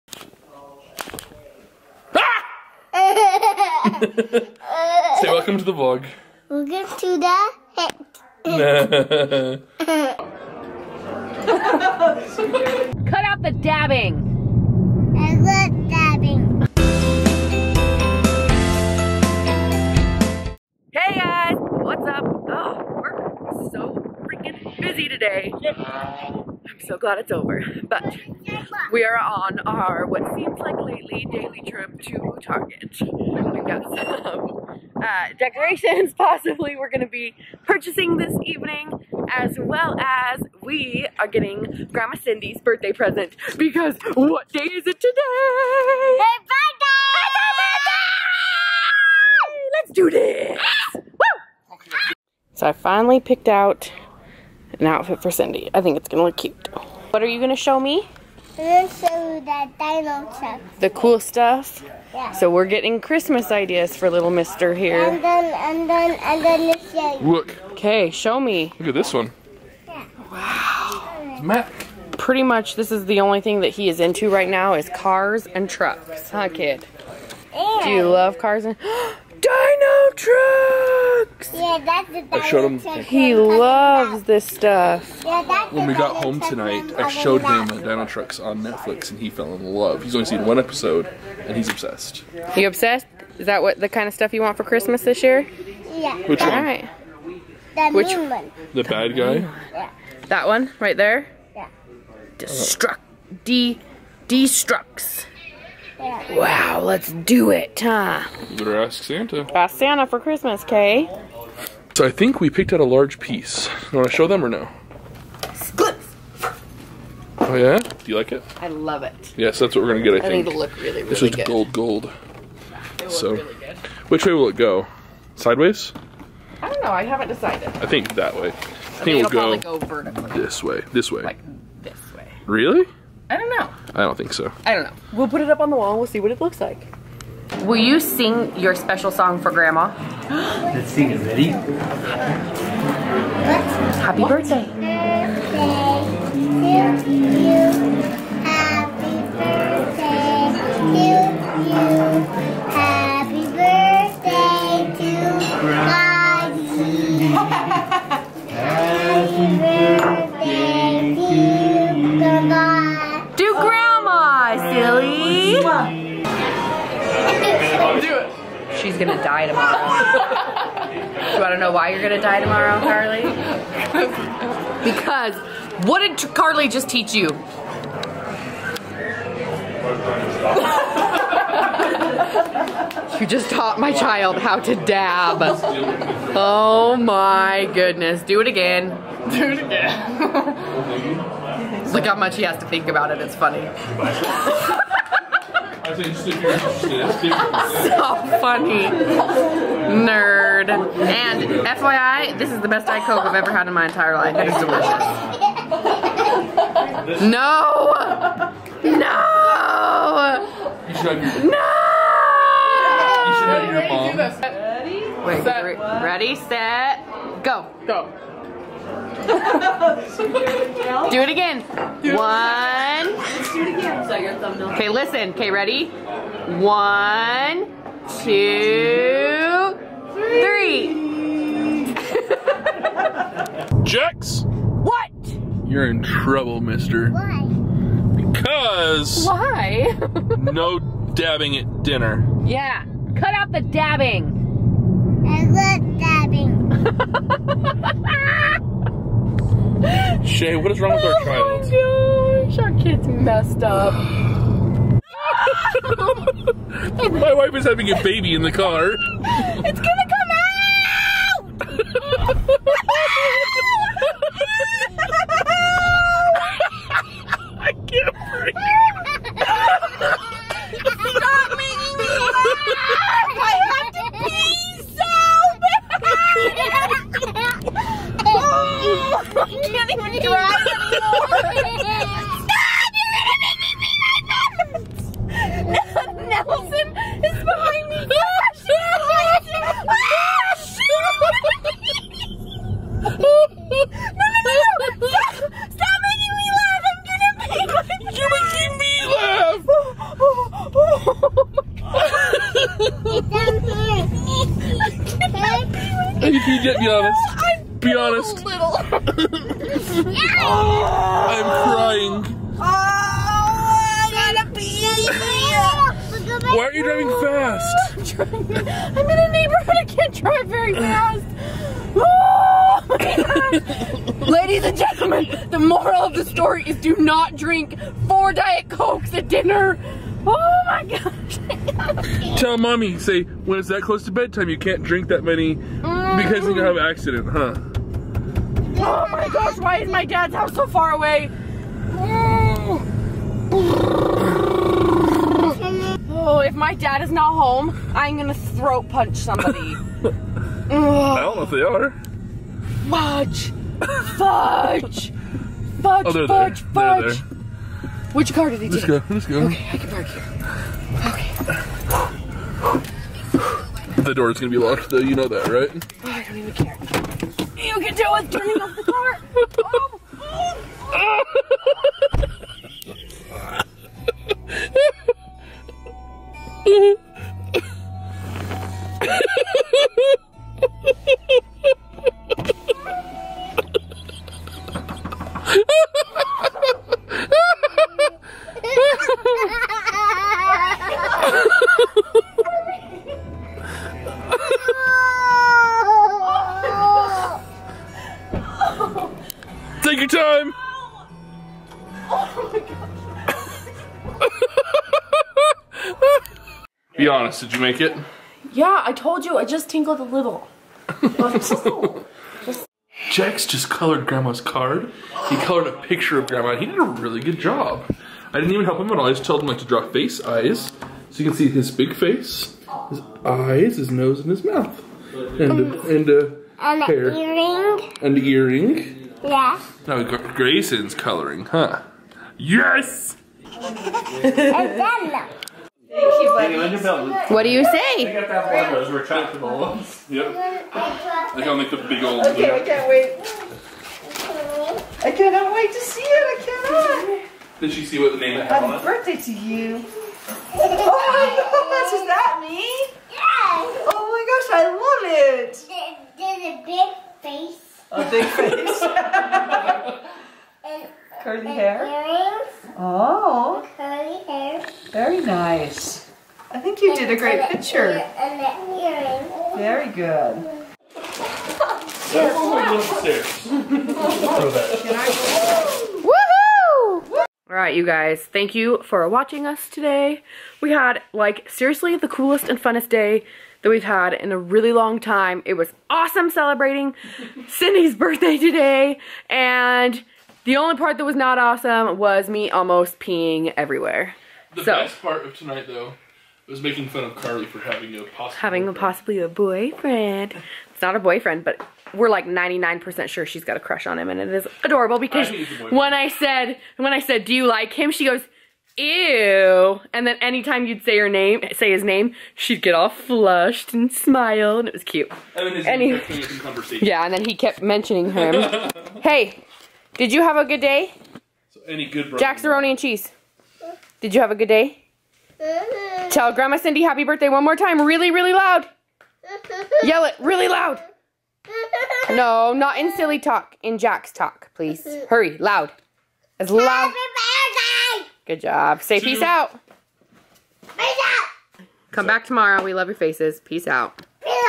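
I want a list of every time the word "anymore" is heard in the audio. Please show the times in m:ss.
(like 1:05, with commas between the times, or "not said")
4:41.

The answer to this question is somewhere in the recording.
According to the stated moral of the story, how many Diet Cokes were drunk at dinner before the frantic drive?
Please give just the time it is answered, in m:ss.
5:28.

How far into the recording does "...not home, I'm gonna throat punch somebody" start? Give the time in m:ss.
5:47.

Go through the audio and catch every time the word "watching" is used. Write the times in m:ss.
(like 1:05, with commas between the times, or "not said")
7:59.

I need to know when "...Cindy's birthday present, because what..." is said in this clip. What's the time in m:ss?
0:42.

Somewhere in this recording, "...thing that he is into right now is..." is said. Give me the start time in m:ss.
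1:13.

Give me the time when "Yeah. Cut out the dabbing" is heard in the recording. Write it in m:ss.
4:02.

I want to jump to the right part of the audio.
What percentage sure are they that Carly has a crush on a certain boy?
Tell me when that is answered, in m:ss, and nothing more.
8:22.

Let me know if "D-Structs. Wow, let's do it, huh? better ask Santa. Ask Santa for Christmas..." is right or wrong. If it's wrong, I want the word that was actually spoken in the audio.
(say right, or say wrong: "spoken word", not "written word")
right.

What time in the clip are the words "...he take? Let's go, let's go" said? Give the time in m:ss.
5:58.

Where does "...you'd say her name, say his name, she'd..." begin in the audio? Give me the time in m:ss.
8:30.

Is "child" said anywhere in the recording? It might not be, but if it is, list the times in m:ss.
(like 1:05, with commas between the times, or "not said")
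3:03, 4:11.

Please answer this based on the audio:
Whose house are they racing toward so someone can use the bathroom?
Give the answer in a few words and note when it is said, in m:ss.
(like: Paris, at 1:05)
Dad's house, at 5:39.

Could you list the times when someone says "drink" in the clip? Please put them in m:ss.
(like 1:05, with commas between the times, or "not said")
5:27, 5:34.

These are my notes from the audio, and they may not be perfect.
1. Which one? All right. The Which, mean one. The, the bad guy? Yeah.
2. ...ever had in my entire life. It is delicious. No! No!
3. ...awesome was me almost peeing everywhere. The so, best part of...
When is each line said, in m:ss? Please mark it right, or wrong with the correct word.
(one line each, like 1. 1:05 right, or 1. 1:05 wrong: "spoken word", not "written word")
1. 1:36 right
2. 3:23 right
3. 8:11 right.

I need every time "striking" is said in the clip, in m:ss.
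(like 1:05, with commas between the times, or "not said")
not said.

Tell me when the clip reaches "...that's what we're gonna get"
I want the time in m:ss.
1:59.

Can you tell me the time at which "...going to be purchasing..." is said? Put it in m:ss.
0:36.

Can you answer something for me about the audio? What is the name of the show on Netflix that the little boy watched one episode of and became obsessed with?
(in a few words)
Dino Trux.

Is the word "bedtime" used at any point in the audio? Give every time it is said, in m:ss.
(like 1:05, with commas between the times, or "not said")
5:34.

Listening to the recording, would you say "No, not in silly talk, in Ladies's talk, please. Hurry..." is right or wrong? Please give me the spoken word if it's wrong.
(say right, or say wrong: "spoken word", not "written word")
wrong: "Jack", not "Ladies".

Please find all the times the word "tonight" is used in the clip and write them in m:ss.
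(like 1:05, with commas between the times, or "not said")
1:26, 8:15.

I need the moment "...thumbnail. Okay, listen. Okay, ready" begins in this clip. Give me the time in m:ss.
3:44.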